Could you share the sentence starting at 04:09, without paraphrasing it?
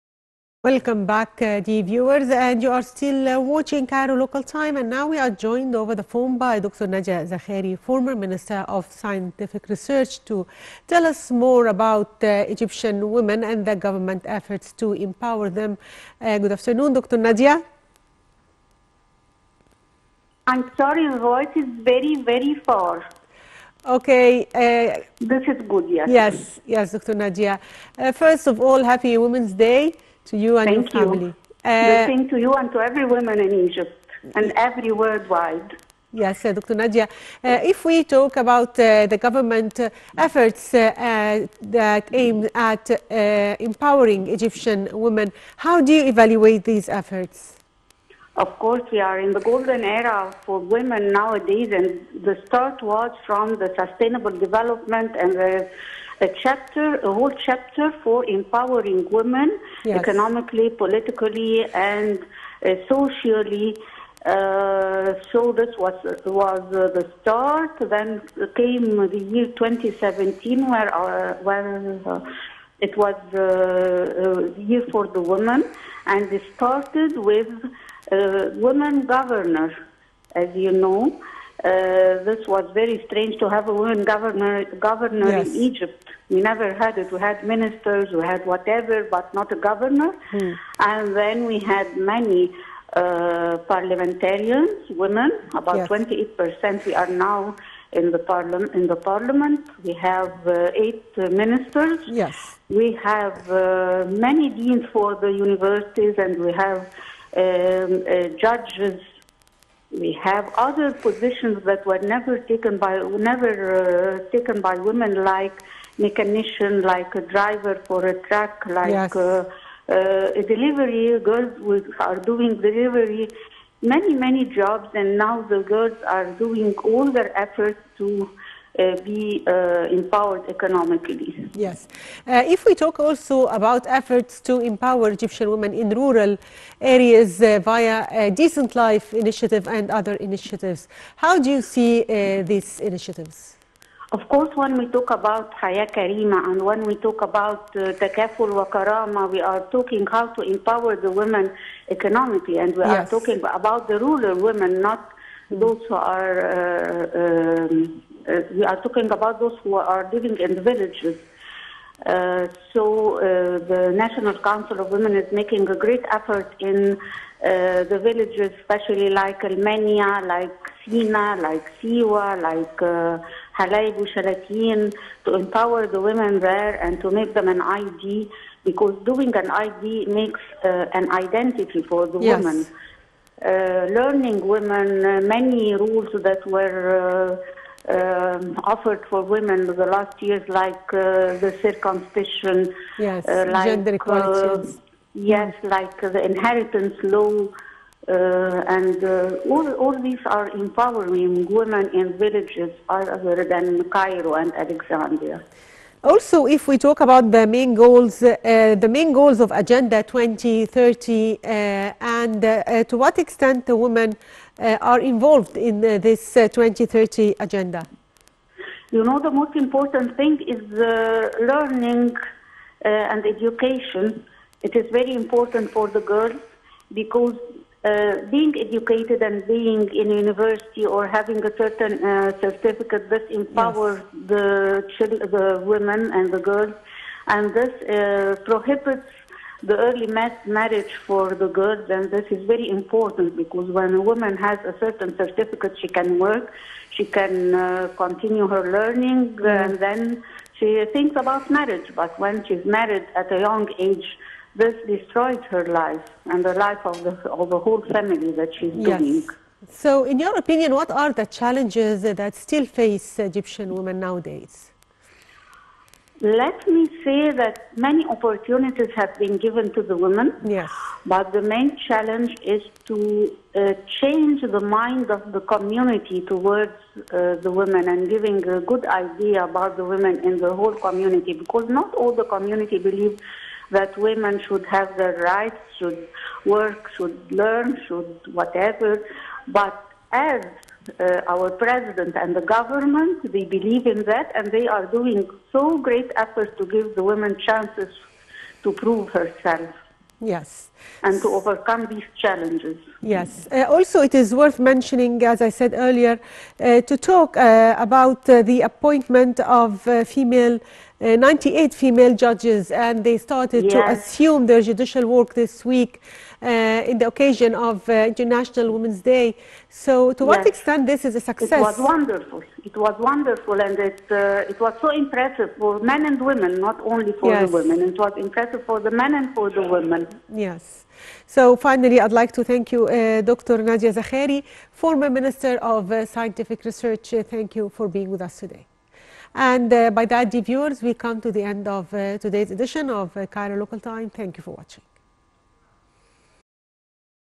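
and then she thinks about marriage.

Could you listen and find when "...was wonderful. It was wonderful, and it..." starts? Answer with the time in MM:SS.
05:21.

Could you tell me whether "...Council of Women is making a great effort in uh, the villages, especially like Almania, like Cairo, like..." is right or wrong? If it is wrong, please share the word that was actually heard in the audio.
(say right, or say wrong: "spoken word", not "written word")
wrong: "Sinai", not "Cairo".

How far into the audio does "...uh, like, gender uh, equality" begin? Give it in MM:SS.
03:13.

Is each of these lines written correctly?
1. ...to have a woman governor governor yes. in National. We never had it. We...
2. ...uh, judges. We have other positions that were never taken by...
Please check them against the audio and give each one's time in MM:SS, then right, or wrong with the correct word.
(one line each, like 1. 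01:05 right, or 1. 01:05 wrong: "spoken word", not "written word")
1. 01:23 wrong: "Egypt", not "National"
2. 01:48 right.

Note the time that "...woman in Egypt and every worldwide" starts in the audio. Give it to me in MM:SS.
00:33.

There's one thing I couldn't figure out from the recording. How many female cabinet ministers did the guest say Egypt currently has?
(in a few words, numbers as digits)
8.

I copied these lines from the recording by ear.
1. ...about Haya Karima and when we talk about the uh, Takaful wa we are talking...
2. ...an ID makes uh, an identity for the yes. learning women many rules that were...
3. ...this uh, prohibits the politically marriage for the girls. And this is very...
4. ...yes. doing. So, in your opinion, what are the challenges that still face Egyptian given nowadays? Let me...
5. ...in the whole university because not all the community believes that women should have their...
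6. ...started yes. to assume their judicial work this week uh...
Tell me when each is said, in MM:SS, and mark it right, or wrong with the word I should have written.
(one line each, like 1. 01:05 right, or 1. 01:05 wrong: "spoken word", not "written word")
1. 02:25 right
2. 02:59 right
3. 03:57 wrong: "early", not "politically"
4. 04:18 wrong: "women", not "given"
5. 04:40 wrong: "community", not "university"
6. 05:13 right.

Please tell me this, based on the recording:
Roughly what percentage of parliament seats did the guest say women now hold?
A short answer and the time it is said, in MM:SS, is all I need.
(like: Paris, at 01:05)
28%, at 01:35.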